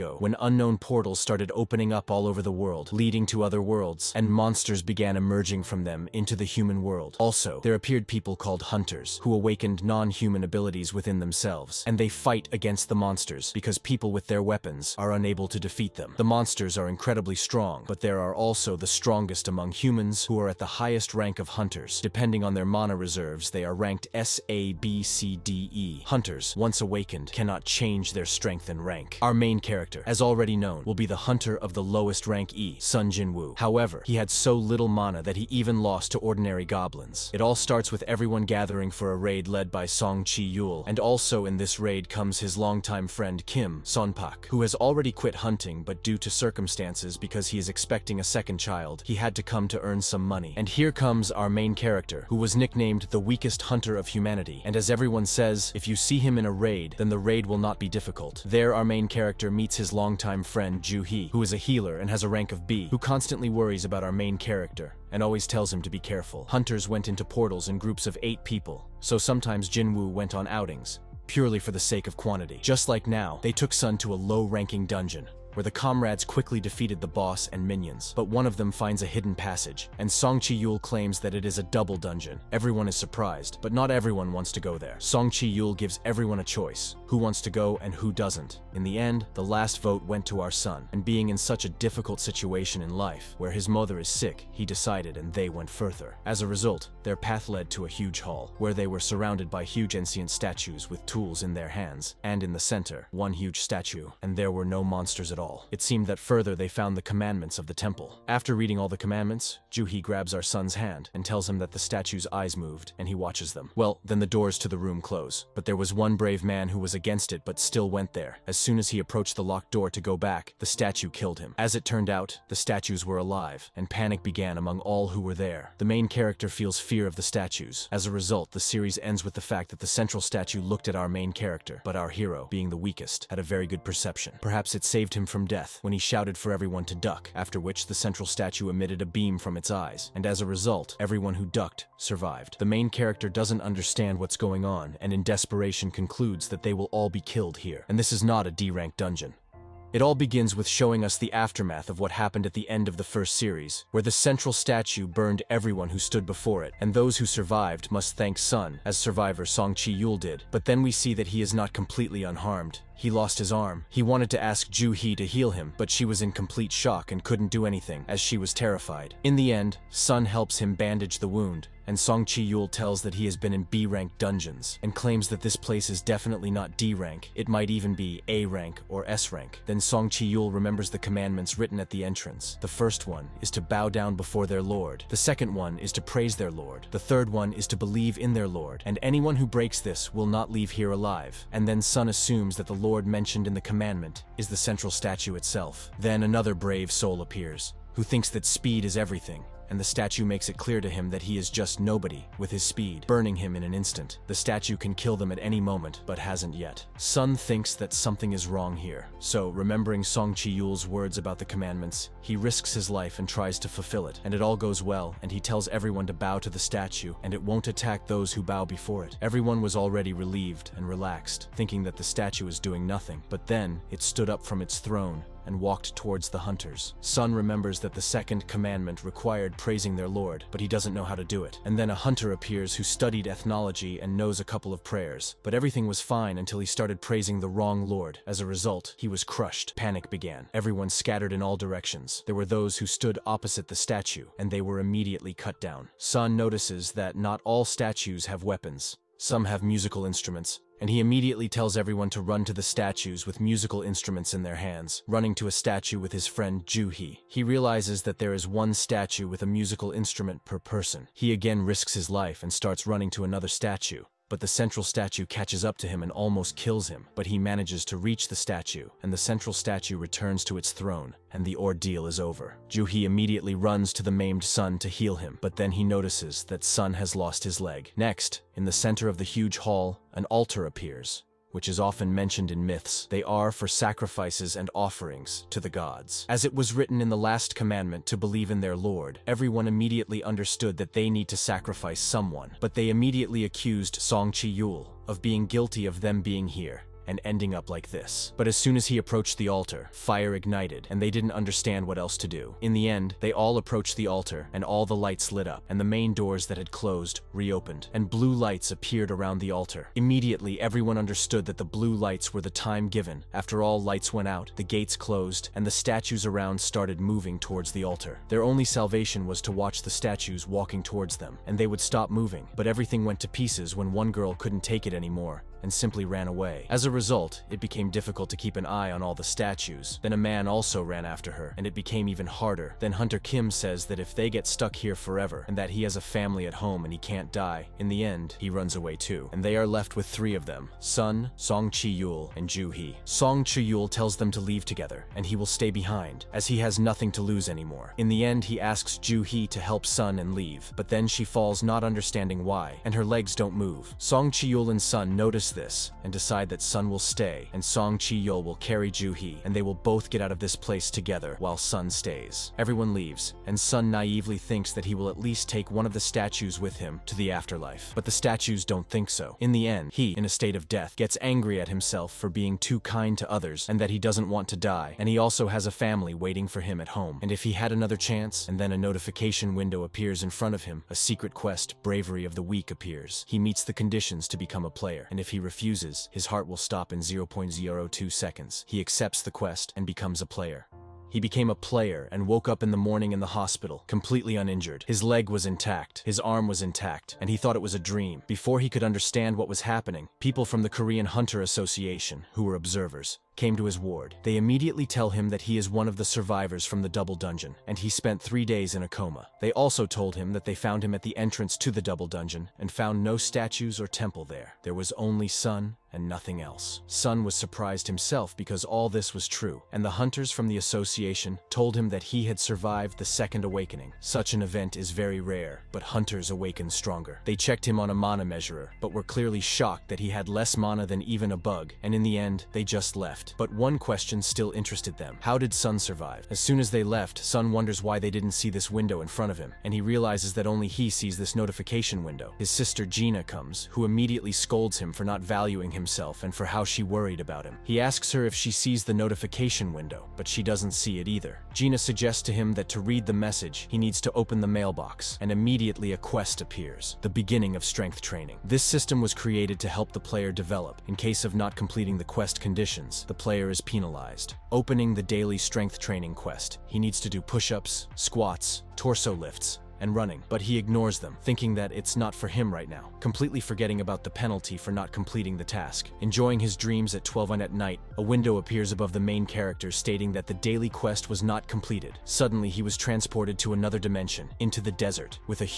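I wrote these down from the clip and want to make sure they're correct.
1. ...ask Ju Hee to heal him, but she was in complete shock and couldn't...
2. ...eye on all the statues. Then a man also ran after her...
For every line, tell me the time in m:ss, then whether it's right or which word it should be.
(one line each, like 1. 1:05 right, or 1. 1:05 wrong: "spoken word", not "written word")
1. 2:44 right
2. 5:28 right.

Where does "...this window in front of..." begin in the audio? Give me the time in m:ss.
7:18.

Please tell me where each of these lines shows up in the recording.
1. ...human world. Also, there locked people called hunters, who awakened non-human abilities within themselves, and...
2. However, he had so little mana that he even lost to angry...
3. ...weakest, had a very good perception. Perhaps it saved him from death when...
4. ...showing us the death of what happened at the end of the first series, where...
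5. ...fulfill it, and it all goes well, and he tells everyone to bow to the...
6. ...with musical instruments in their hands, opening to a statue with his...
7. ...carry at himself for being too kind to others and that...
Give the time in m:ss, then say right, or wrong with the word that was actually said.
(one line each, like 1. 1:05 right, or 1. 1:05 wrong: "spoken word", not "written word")
1. 0:06 wrong: "appeared", not "locked"
2. 0:33 wrong: "ordinary", not "angry"
3. 2:12 right
4. 2:30 wrong: "aftermath", not "death"
5. 3:33 right
6. 4:13 wrong: "running", not "opening"
7. 6:11 wrong: "angry", not "carry".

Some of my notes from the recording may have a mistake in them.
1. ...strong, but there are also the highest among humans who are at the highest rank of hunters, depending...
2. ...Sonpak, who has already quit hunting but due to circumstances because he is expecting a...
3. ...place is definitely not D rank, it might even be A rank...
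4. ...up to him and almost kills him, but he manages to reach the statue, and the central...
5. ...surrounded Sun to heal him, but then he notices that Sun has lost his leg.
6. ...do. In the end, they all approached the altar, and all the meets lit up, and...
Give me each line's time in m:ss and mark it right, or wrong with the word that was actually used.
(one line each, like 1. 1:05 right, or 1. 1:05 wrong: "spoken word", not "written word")
1. 0:17 wrong: "strongest", not "highest"
2. 0:43 right
3. 2:55 right
4. 4:25 right
5. 4:34 wrong: "maimed", not "surrounded"
6. 5:02 wrong: "lights", not "meets".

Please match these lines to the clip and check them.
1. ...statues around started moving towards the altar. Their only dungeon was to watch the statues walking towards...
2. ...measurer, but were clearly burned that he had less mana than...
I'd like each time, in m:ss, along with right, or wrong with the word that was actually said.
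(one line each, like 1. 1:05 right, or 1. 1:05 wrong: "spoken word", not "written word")
1. 5:15 wrong: "salvation", not "dungeon"
2. 7:08 wrong: "shocked", not "burned".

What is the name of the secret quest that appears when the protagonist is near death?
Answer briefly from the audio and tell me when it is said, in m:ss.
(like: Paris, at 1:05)
Bravery of the Weak, at 6:21.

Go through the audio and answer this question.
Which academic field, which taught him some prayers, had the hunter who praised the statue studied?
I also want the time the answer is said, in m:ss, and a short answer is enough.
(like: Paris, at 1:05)
Ethnology, at 3:53.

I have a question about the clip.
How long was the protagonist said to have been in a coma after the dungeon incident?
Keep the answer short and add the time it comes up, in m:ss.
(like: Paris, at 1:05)
3 days, at 6:48.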